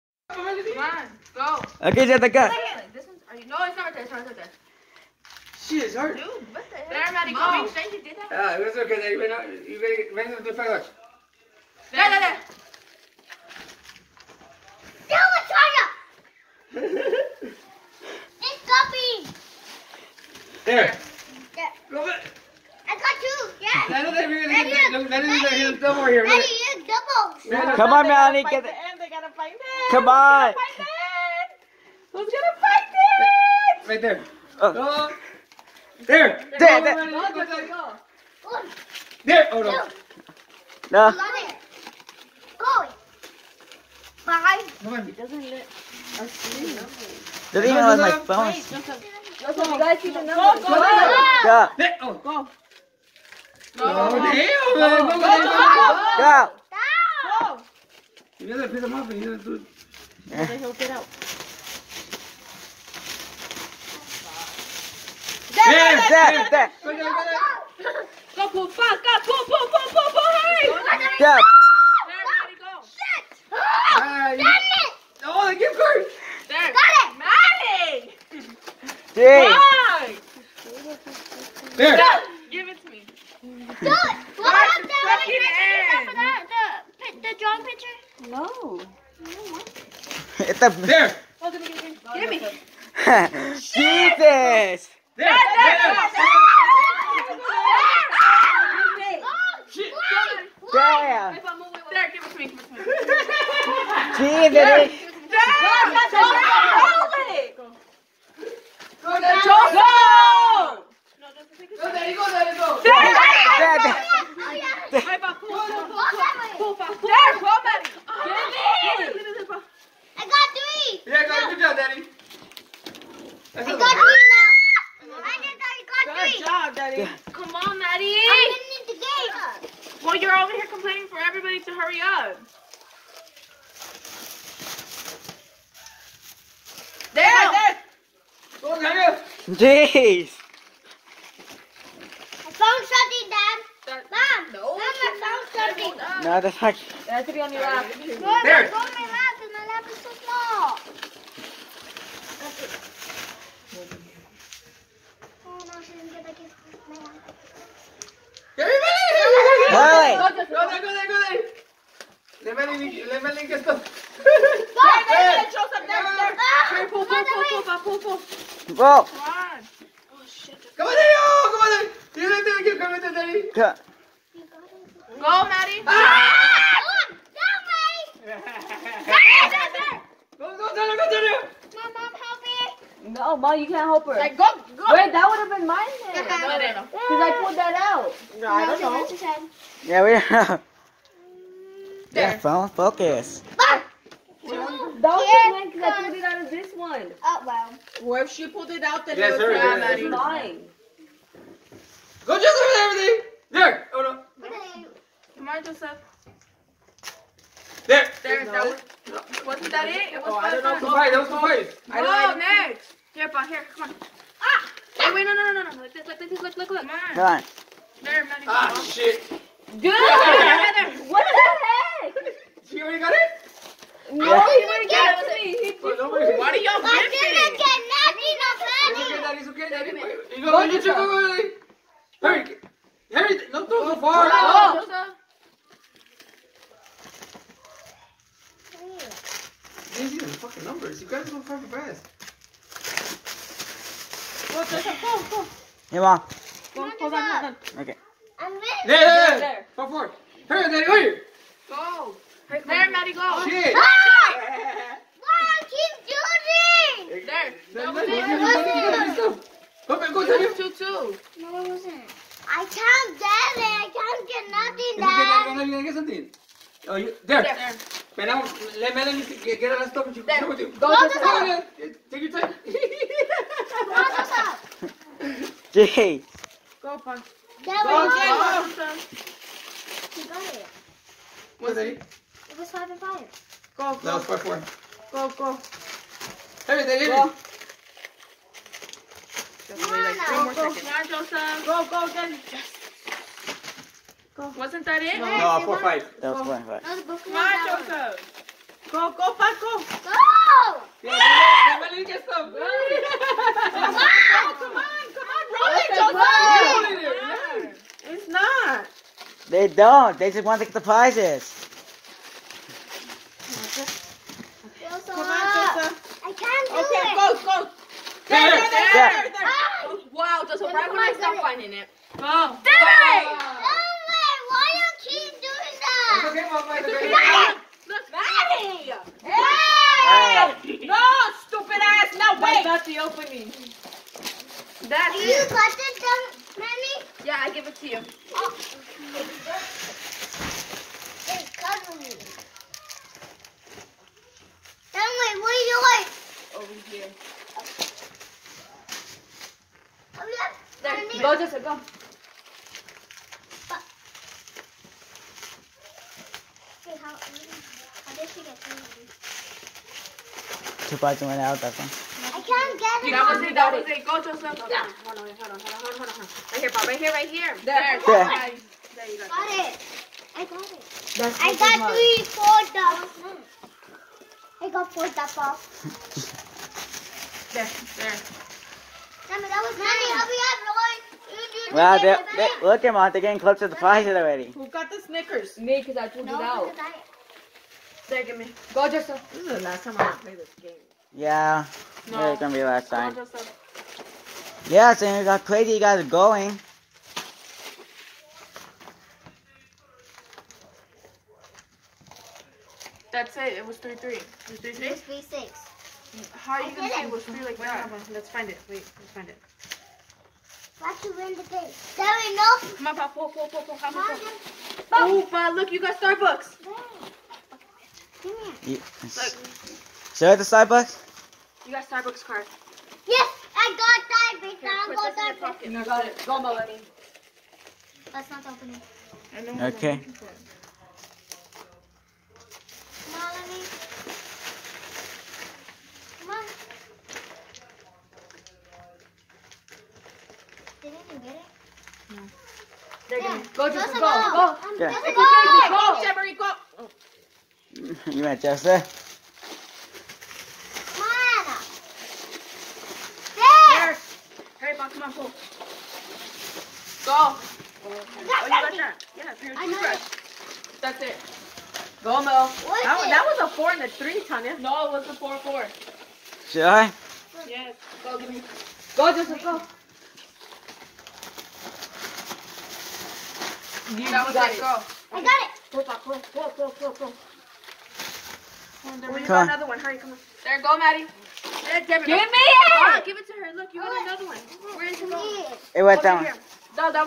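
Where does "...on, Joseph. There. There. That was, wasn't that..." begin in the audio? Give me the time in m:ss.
3:25.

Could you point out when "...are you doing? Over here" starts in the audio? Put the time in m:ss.
5:45.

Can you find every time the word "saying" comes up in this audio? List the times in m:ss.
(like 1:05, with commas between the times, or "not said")
6:34.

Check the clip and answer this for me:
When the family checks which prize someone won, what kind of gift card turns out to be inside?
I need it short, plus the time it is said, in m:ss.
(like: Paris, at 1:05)
Starbucks card, at 7:01.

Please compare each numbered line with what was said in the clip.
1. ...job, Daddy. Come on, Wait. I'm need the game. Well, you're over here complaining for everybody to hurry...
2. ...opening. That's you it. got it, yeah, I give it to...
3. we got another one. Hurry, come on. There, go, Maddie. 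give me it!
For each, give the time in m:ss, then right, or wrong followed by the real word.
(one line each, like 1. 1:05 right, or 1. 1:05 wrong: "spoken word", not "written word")
1. 2:06 wrong: "Maddie", not "Wait"
2. 5:32 right
3. 7:59 right.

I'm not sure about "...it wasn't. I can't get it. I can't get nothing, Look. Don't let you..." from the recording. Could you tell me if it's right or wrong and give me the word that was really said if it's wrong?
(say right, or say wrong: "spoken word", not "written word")
wrong: "Dad", not "Look".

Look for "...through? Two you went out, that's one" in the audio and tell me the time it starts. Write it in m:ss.
5:58.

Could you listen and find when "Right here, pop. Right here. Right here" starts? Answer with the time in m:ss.
6:06.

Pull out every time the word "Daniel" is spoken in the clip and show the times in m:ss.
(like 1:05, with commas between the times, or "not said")
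2:18.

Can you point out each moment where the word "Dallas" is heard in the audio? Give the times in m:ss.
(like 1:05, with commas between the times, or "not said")
not said.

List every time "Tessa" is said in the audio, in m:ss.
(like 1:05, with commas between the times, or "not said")
5:15.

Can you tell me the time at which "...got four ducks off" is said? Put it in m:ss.
6:14.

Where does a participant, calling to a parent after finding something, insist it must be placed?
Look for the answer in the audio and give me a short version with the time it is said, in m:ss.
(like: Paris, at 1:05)
on your lap, at 2:27.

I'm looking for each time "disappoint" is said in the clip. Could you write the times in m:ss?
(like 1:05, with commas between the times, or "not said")
not said.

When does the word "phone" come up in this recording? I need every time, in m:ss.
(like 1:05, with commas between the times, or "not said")
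0:48, 3:12.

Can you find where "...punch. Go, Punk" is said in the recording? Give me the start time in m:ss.
4:36.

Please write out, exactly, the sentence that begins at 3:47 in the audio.
I didn't get nothing of Daddy's okay, Daddy.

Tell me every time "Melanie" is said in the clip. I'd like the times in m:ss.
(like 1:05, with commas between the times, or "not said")
4:28.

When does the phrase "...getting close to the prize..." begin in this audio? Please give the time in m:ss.
6:23.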